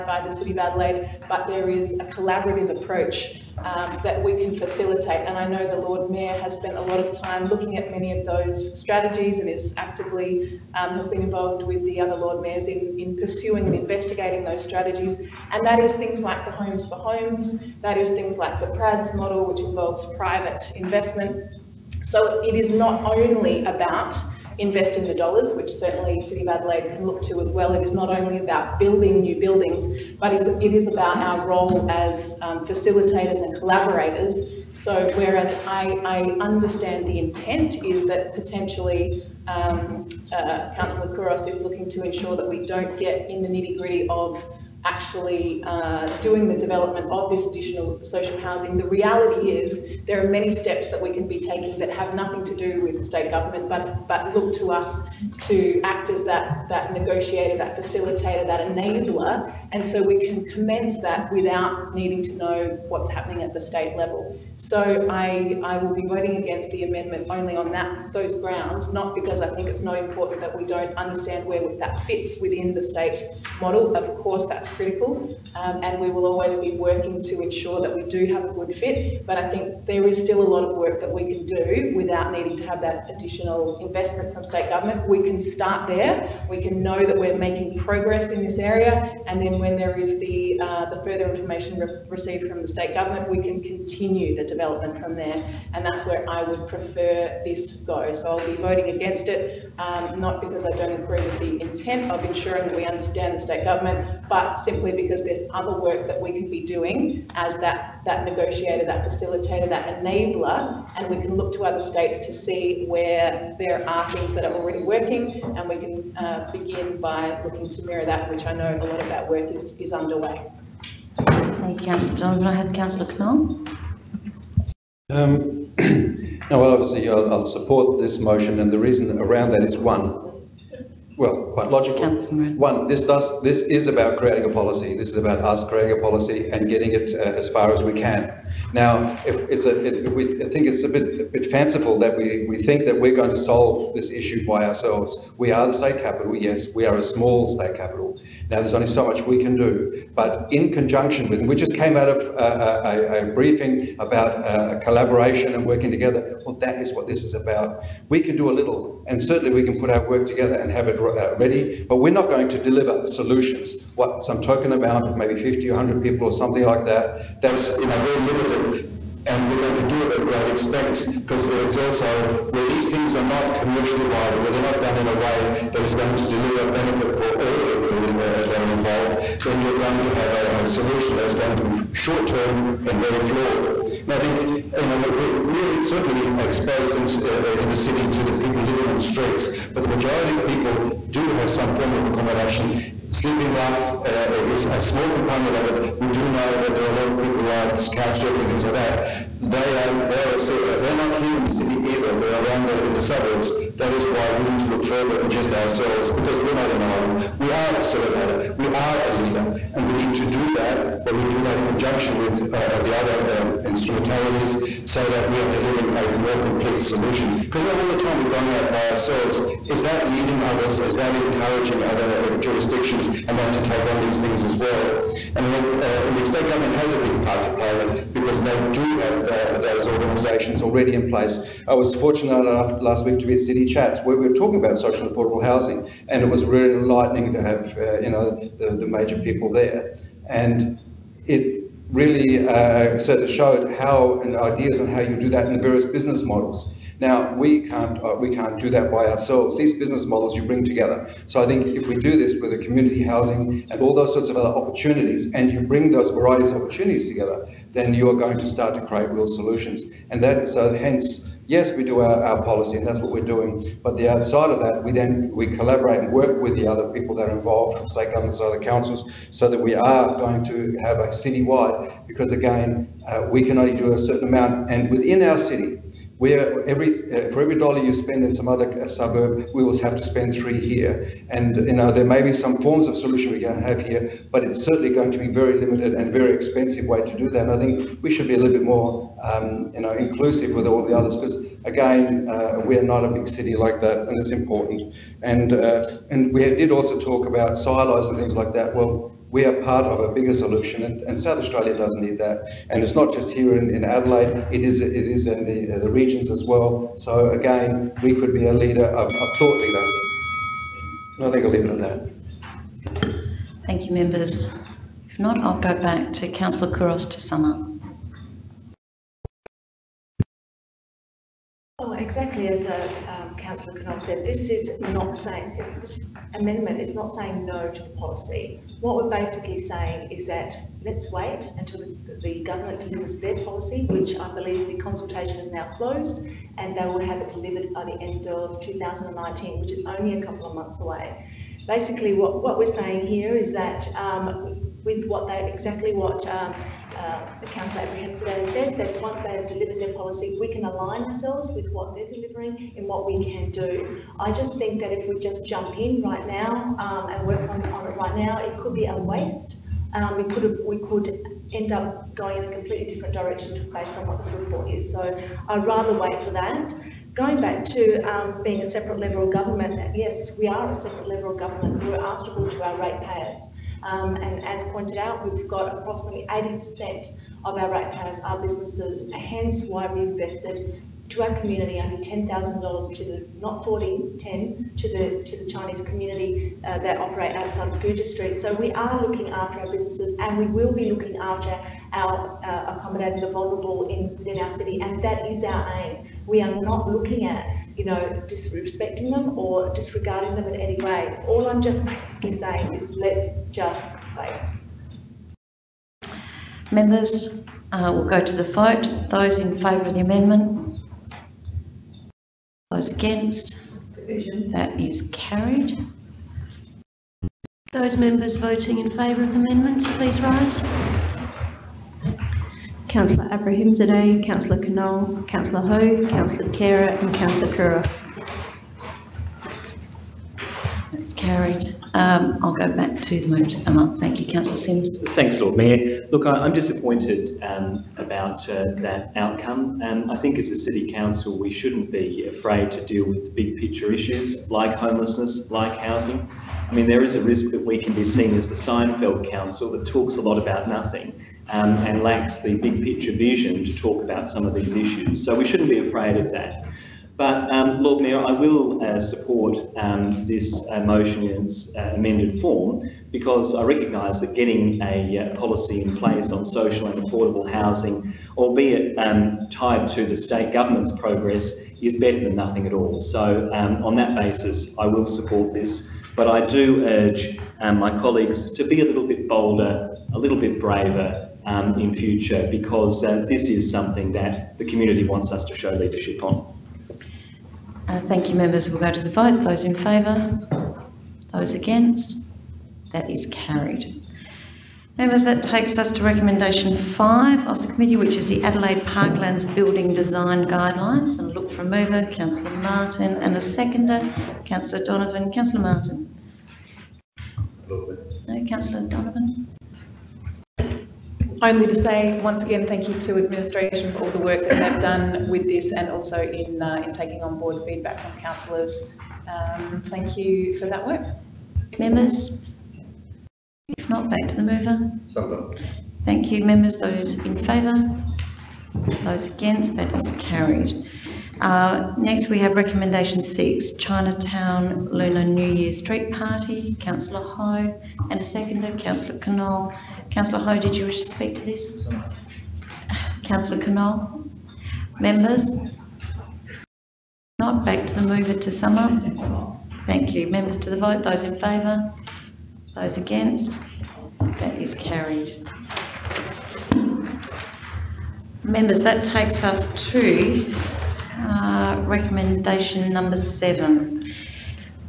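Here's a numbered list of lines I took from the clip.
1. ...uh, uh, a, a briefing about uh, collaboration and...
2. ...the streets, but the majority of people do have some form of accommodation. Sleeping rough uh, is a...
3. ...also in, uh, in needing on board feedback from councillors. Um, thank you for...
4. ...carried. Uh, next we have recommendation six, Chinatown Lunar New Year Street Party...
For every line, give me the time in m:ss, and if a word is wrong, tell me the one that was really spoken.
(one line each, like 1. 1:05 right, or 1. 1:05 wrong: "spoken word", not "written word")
1. 2:32 right
2. 3:08 right
3. 8:35 wrong: "taking", not "needing"
4. 8:50 right.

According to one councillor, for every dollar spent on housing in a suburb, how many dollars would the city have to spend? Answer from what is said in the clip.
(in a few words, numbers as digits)
3.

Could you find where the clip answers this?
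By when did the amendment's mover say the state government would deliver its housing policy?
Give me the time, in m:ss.
5:38.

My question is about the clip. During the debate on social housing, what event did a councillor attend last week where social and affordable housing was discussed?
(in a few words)
City Chats.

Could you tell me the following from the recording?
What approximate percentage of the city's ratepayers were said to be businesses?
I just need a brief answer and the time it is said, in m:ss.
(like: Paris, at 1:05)
80%, at 6:16.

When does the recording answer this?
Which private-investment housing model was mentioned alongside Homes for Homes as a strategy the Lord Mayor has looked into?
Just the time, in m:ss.
0:18.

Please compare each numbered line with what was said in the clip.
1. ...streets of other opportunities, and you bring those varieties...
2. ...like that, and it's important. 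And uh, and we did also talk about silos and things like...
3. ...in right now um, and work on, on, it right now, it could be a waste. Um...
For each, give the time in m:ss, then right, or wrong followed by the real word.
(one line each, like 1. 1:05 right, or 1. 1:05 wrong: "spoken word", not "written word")
1. 4:14 wrong: "sorts", not "streets"
2. 4:53 right
3. 5:55 right.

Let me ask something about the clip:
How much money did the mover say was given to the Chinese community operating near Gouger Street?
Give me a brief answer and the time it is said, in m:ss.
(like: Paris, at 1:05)
$10,000, at 6:21.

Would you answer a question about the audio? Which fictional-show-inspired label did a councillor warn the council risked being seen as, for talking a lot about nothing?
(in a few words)
Seinfeld Council.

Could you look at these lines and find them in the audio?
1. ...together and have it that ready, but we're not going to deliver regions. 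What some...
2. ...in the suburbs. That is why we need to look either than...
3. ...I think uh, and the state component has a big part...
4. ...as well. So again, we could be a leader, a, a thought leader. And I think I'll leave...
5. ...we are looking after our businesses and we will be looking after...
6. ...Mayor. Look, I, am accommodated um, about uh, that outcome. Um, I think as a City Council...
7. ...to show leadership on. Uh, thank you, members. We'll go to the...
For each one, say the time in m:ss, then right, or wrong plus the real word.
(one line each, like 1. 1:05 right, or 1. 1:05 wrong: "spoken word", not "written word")
1. 2:40 wrong: "solutions", not "regions"
2. 3:22 wrong: "further", not "either"
3. 3:45 wrong: "government", not "component"
4. 5:06 right
5. 6:28 right
6. 7:15 wrong: "disappointed", not "accommodated"
7. 8:05 right.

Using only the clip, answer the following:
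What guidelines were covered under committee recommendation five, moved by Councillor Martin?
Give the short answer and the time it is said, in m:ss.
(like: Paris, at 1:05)
Adelaide Parklands Building Design Guidelines, at 8:18.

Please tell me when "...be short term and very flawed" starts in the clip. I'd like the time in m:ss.
3:01.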